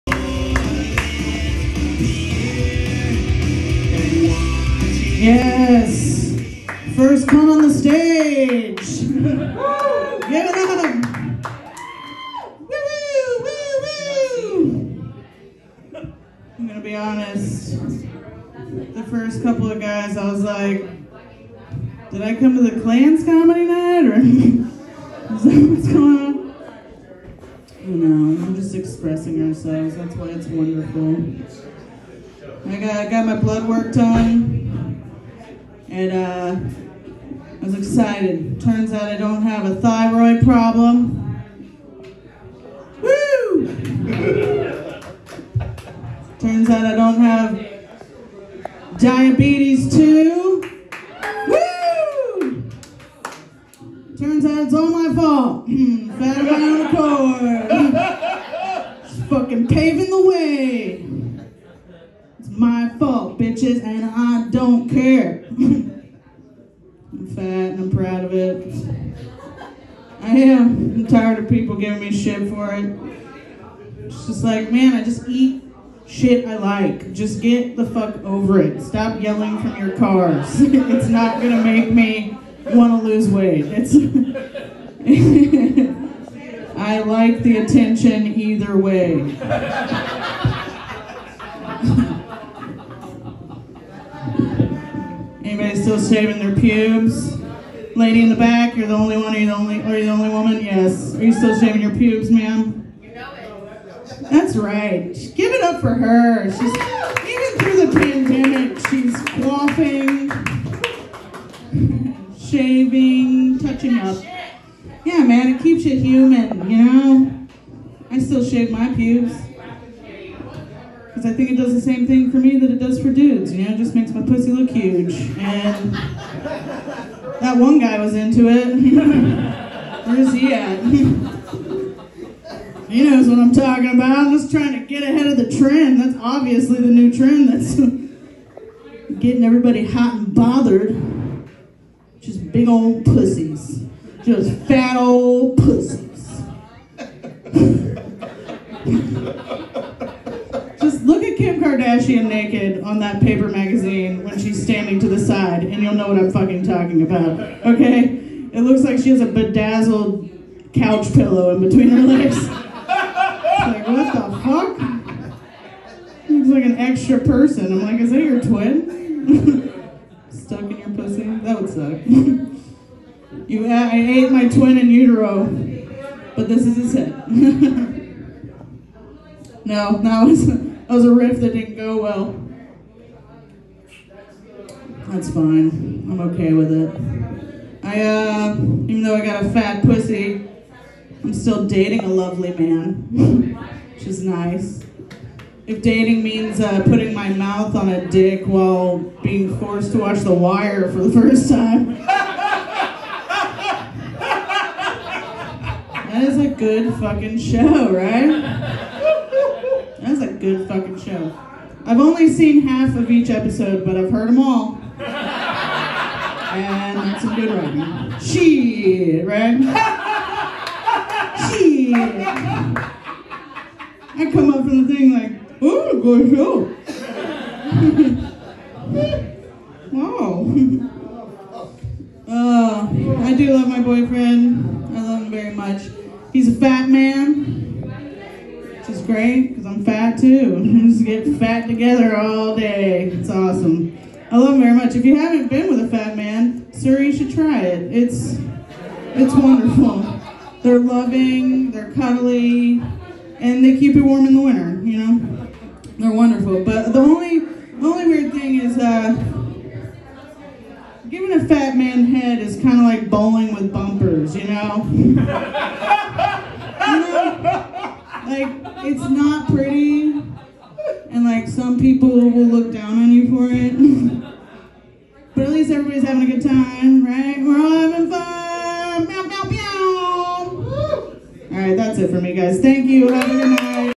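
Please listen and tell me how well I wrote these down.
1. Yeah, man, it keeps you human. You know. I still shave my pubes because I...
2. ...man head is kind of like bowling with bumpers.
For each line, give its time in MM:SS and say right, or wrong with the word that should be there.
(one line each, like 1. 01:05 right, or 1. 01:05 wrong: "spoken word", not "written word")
1. 01:55 right
2. 04:21 right.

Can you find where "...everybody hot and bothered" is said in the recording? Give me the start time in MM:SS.
02:19.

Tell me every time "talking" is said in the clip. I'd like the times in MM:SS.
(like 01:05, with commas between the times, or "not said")
02:13, 02:36.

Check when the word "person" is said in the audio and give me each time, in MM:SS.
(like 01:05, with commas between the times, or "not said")
02:47.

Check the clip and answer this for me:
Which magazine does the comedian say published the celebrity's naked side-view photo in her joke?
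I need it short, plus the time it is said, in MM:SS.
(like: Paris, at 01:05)
Paper, at 02:33.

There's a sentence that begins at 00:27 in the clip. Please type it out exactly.
You know, we're just expressing ourselves.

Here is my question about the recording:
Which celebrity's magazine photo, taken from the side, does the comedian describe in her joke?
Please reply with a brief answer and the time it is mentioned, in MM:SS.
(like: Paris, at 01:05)
Kim Kardashian, at 02:31.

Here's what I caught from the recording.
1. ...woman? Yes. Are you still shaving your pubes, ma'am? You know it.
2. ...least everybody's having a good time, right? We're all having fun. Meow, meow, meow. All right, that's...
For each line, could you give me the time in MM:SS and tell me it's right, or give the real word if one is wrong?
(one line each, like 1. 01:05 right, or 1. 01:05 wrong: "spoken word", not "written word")
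1. 01:40 right
2. 04:35 right.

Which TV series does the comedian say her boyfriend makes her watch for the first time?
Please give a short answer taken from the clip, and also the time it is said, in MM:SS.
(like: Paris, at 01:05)
The Wire, at 03:20.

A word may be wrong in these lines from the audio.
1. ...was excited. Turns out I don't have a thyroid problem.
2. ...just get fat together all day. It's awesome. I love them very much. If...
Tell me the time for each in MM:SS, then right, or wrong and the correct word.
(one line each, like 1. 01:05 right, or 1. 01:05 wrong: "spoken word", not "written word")
1. 00:37 right
2. 04:00 right.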